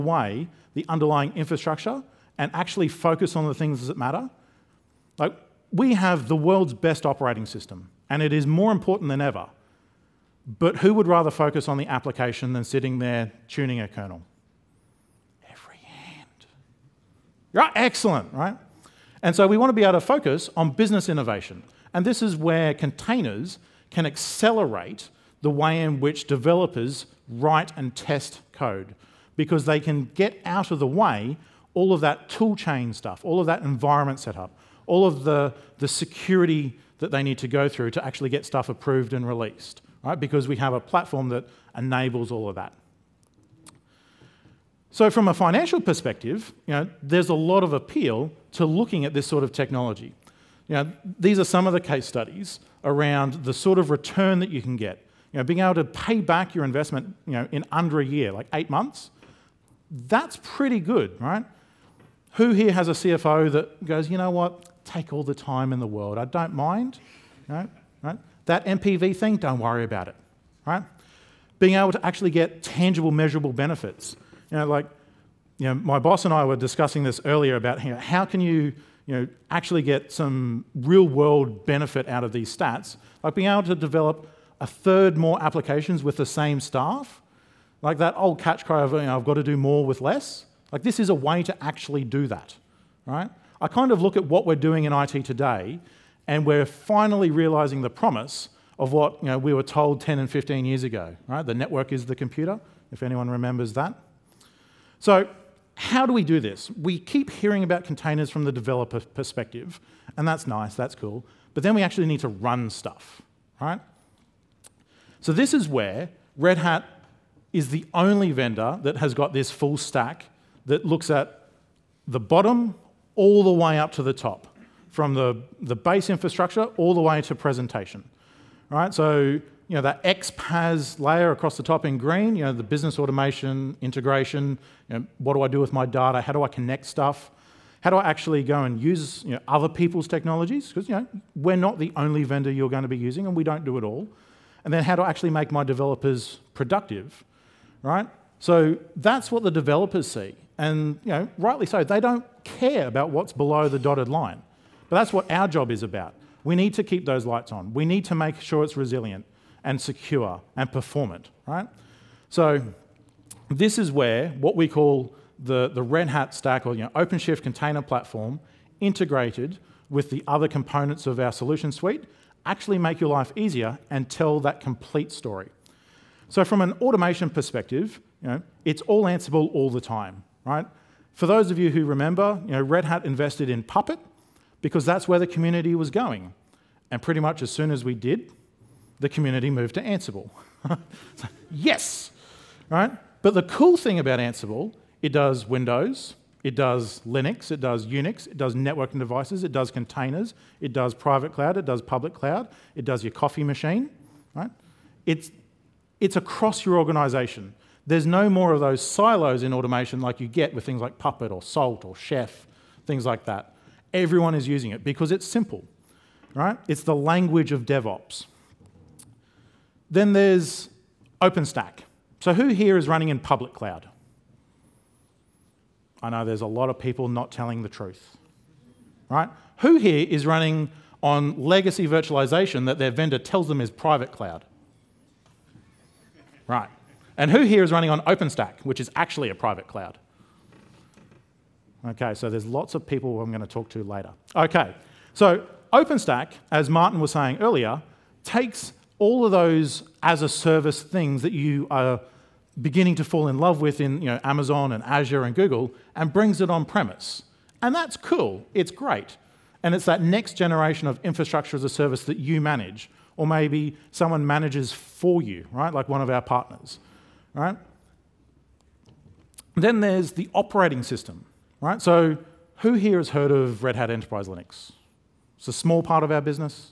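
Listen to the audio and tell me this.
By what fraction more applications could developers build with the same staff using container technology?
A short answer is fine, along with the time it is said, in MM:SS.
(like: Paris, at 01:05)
a third, at 01:24.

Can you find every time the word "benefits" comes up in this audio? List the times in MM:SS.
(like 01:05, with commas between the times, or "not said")
01:13, 01:21.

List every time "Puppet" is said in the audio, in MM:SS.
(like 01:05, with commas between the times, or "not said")
03:03, 03:30.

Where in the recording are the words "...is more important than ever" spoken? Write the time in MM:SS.
00:08.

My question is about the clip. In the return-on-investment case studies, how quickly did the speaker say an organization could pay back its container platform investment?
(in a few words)
8 months.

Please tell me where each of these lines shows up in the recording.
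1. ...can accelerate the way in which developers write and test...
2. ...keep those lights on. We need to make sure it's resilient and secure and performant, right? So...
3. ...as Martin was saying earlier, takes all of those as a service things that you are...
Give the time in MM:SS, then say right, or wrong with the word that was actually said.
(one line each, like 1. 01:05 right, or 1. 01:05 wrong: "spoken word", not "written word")
1. 00:23 right
2. 02:36 right
3. 04:06 right.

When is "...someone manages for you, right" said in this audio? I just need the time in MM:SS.
04:23.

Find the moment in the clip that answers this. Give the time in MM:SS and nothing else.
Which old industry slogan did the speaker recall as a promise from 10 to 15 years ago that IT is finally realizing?
01:41.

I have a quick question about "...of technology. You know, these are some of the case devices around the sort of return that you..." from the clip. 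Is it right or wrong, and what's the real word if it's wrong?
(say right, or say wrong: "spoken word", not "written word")
wrong: "studies", not "devices".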